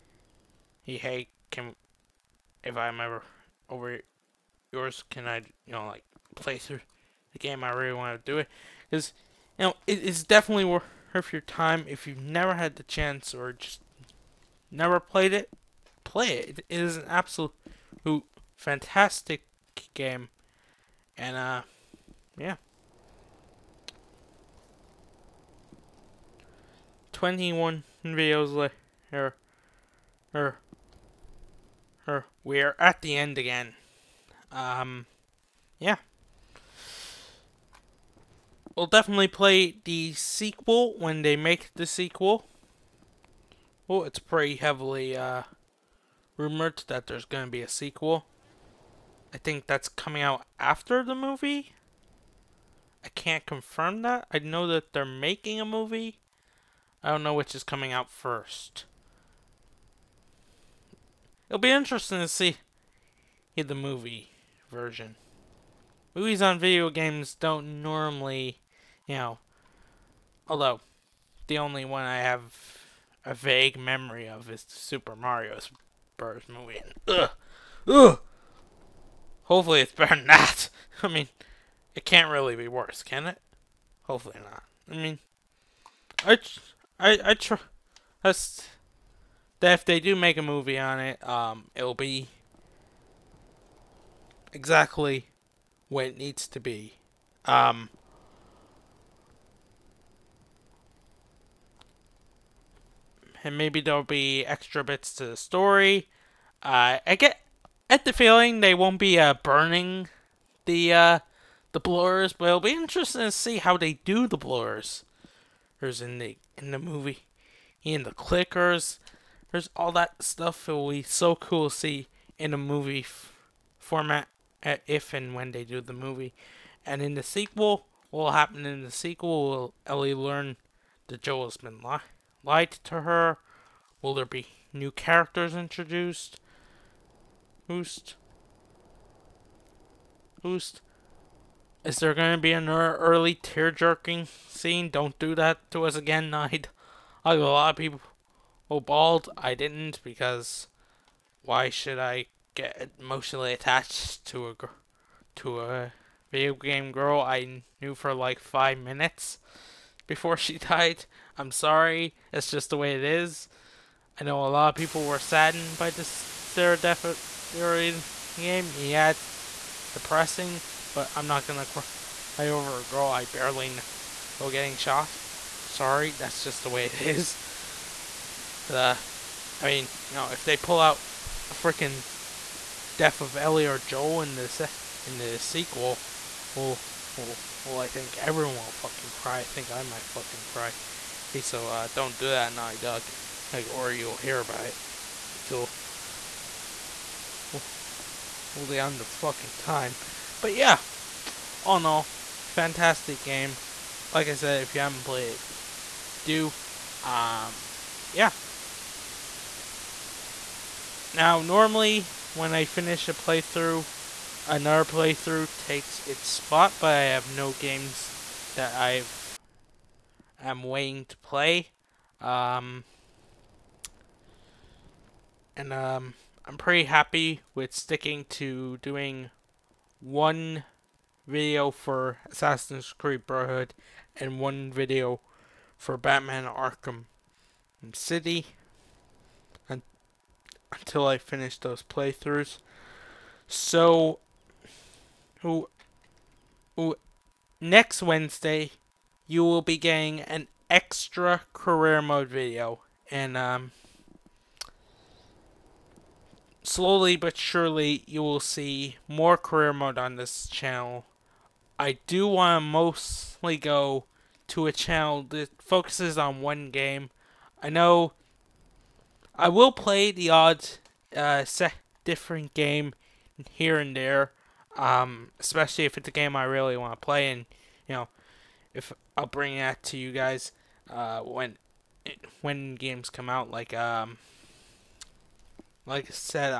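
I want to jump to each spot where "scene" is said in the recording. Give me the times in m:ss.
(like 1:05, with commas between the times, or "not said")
2:24.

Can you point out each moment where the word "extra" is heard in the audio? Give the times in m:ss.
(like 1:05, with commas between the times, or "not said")
1:44, 4:10.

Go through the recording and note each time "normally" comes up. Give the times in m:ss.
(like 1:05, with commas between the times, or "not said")
1:07, 3:31.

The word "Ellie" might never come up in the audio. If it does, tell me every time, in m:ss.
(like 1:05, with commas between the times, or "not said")
2:09, 3:03.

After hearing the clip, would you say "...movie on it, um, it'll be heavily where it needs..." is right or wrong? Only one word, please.
wrong.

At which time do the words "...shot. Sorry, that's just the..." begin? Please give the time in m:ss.
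2:54.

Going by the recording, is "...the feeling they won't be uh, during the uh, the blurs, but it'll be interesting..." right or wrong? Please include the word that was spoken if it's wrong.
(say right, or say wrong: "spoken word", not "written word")
wrong: "burning", not "during".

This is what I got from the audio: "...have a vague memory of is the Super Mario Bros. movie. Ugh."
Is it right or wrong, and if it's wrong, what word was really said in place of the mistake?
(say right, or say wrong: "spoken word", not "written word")
right.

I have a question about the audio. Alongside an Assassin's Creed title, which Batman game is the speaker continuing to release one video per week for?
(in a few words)
Batman Arkham City.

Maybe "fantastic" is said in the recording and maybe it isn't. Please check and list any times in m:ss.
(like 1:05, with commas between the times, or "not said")
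0:18, 3:22.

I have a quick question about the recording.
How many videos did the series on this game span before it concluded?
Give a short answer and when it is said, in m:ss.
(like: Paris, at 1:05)
21, at 0:27.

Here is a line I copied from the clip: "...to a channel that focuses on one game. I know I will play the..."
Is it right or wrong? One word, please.
right.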